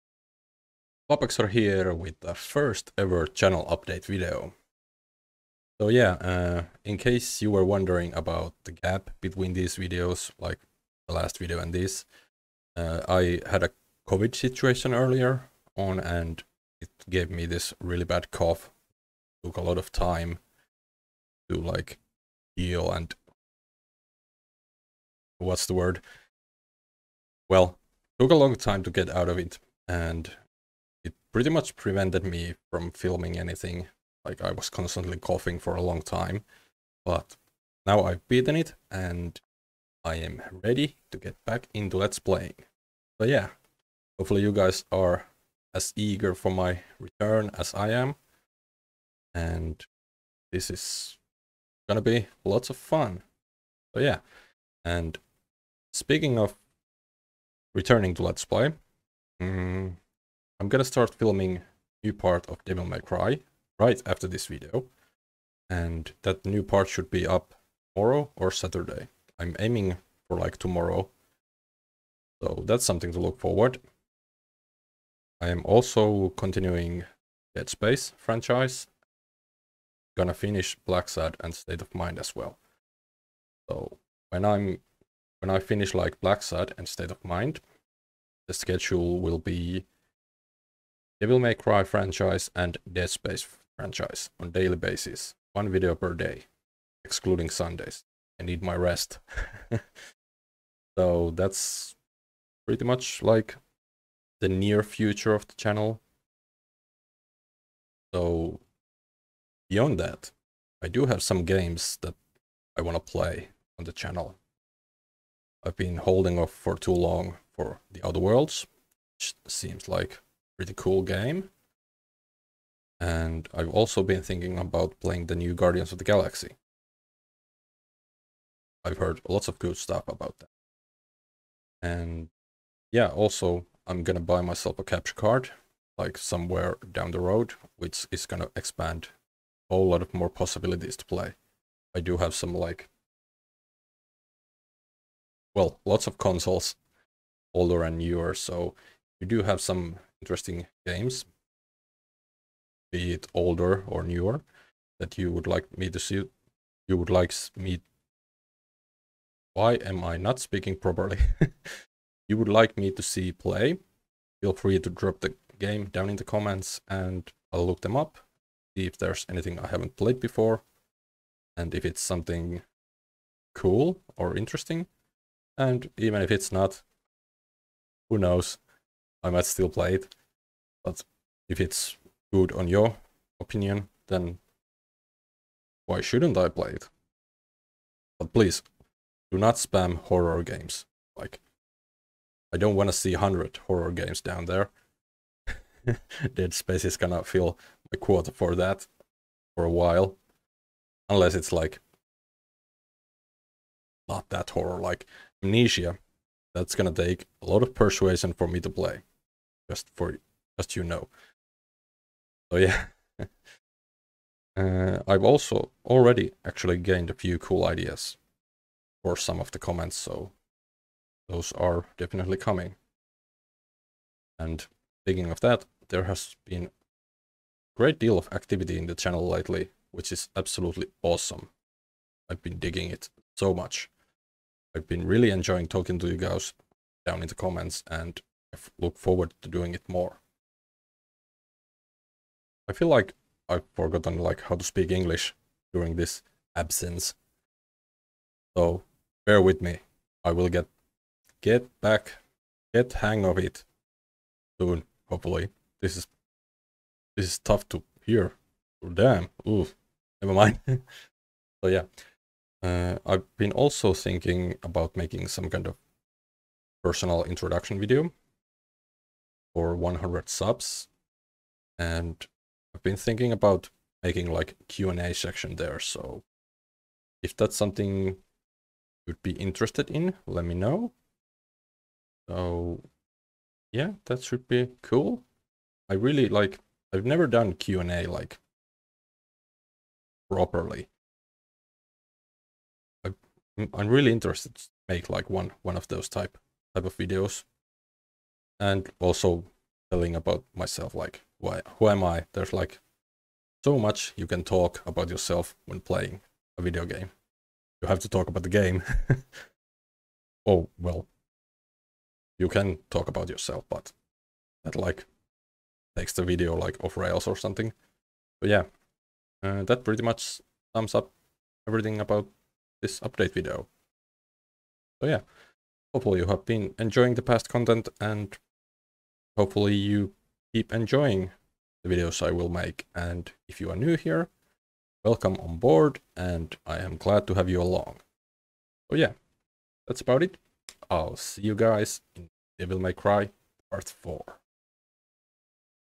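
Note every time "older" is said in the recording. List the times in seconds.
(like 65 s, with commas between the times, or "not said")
147 s, 153 s.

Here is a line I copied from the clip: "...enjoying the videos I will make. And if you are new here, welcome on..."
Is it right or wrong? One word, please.
right.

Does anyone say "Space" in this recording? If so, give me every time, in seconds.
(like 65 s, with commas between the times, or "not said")
77 s, 93 s, 196 s.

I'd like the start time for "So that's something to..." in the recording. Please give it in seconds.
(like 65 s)
72 s.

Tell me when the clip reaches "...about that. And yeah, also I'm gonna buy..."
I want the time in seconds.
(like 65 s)
130 s.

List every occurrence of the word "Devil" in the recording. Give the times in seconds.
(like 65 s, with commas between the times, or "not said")
62 s, 91 s, 342 s.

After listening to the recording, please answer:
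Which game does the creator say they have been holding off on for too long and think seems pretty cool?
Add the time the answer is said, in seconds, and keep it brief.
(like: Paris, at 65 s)
The Outer Worlds, at 117 s.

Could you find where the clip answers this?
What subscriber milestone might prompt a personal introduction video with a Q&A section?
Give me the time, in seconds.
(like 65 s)
269 s.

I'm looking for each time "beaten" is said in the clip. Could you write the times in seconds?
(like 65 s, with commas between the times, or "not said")
38 s.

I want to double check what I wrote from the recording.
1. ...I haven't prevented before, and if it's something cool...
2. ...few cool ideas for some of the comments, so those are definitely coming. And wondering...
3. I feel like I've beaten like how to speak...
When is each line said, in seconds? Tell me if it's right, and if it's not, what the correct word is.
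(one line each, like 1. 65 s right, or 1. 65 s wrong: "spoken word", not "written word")
1. 169 s wrong: "played", not "prevented"
2. 217 s wrong: "speaking", not "wondering"
3. 242 s wrong: "forgotten", not "beaten".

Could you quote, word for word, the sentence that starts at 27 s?
Well, took a long time to get out of it and it pretty much prevented me from filming anything.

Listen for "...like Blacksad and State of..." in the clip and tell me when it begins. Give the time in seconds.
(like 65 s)
85 s.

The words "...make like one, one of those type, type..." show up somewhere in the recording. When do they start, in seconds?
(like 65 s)
294 s.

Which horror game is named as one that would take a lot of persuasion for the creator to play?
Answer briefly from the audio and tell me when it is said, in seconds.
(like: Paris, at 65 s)
Amnesia, at 205 s.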